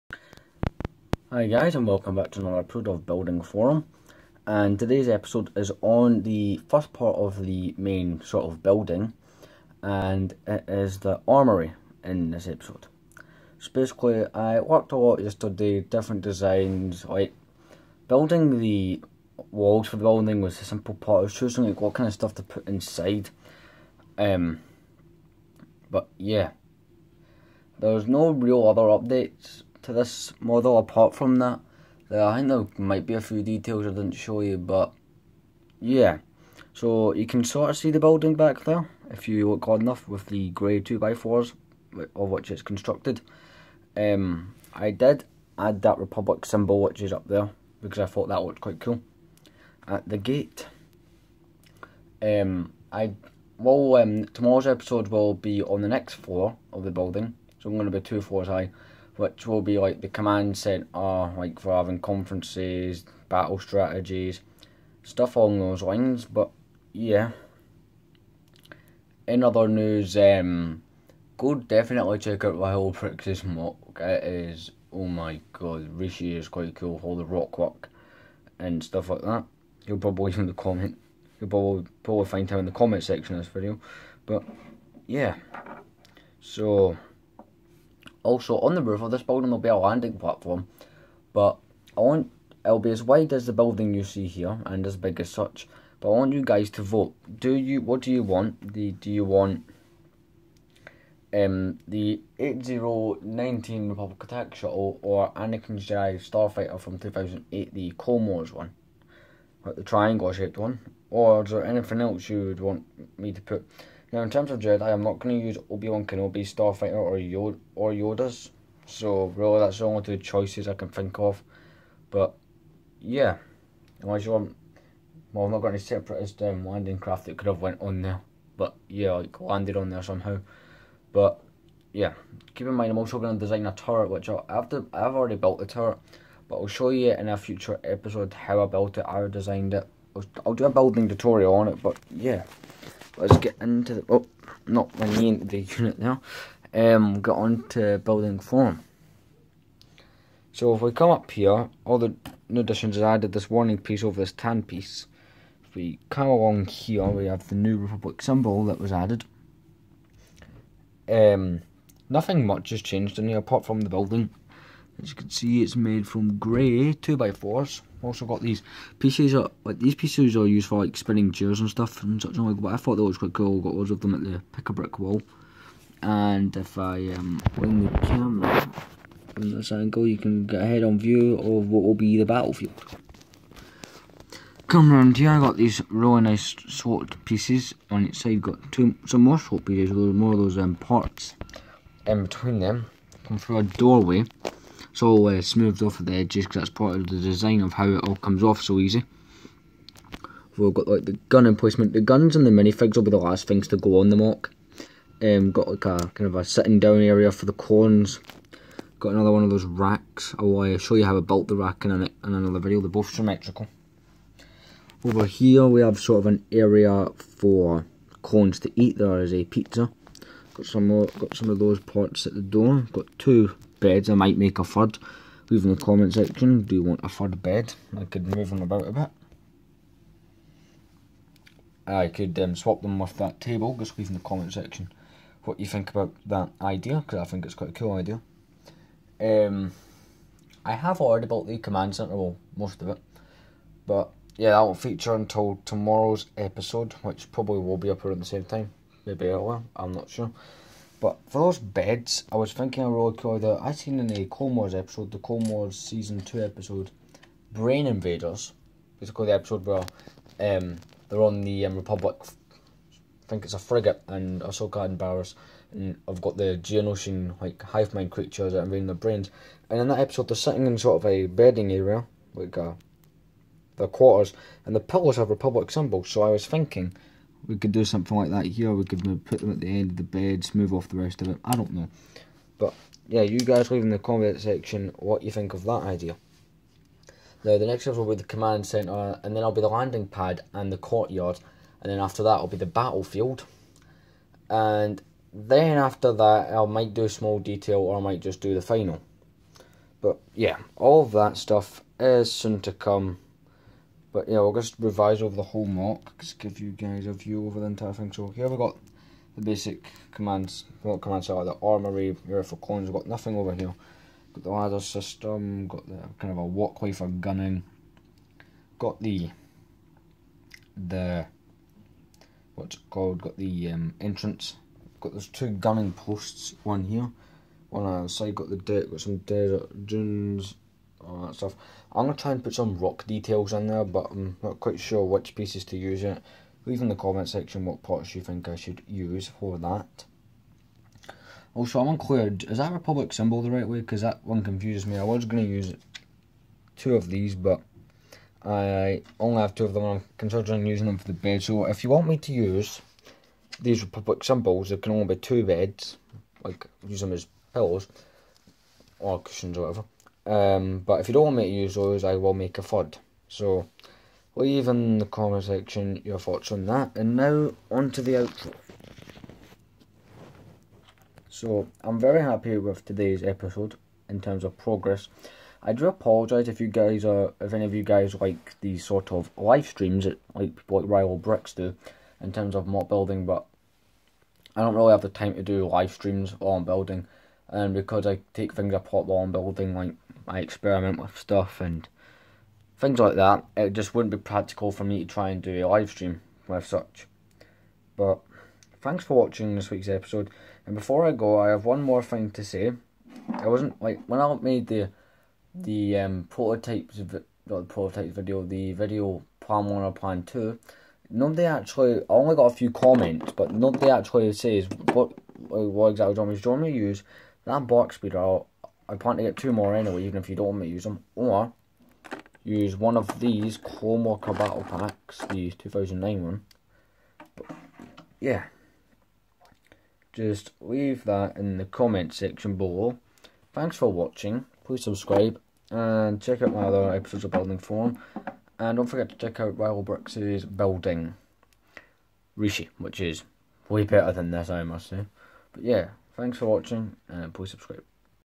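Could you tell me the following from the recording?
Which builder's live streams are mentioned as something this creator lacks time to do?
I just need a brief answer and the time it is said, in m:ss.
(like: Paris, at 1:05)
Rival Bricks, at 6:20.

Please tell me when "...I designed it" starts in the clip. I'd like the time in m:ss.
2:19.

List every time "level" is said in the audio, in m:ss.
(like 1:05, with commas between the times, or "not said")
4:47.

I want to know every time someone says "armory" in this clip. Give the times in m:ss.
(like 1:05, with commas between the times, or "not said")
0:11, 5:11.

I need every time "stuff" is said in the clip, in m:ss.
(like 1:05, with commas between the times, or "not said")
0:22, 1:05, 1:18, 2:51, 5:01, 5:31, 6:31.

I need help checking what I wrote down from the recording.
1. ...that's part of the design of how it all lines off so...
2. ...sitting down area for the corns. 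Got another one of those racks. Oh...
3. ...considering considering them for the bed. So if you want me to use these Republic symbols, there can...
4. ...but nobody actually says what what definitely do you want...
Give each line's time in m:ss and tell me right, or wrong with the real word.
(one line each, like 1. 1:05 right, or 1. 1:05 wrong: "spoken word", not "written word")
1. 3:16 wrong: "comes", not "lines"
2. 3:26 right
3. 5:50 wrong: "using", not "considering"
4. 6:53 wrong: "exactly", not "definitely".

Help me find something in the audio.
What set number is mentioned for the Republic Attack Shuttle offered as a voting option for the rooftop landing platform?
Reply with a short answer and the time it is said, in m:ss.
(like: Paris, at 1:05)
8019, at 1:42.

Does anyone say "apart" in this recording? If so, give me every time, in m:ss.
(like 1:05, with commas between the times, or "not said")
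0:30, 2:43, 6:28.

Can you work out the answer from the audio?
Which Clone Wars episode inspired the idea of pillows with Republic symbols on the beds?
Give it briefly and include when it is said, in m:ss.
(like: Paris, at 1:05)
Brain Invaders, at 4:17.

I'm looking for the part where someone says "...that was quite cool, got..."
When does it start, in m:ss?
2:52.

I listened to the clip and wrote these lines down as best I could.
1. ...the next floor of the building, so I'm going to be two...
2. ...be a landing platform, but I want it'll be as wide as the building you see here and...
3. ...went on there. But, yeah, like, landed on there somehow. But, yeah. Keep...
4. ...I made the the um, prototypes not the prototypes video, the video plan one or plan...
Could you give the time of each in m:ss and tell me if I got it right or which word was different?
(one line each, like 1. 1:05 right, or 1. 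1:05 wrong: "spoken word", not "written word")
1. 0:55 right
2. 1:29 right
3. 2:07 right
4. 6:44 right.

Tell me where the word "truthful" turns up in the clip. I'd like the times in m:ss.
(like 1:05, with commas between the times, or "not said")
not said.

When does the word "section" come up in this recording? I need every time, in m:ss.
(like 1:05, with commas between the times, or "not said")
1:23, 3:46, 3:54, 4:44, 5:37, 6:05, 7:12.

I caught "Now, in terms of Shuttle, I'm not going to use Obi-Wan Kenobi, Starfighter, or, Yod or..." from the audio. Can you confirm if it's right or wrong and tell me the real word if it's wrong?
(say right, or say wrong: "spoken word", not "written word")
wrong: "Jedi", not "Shuttle".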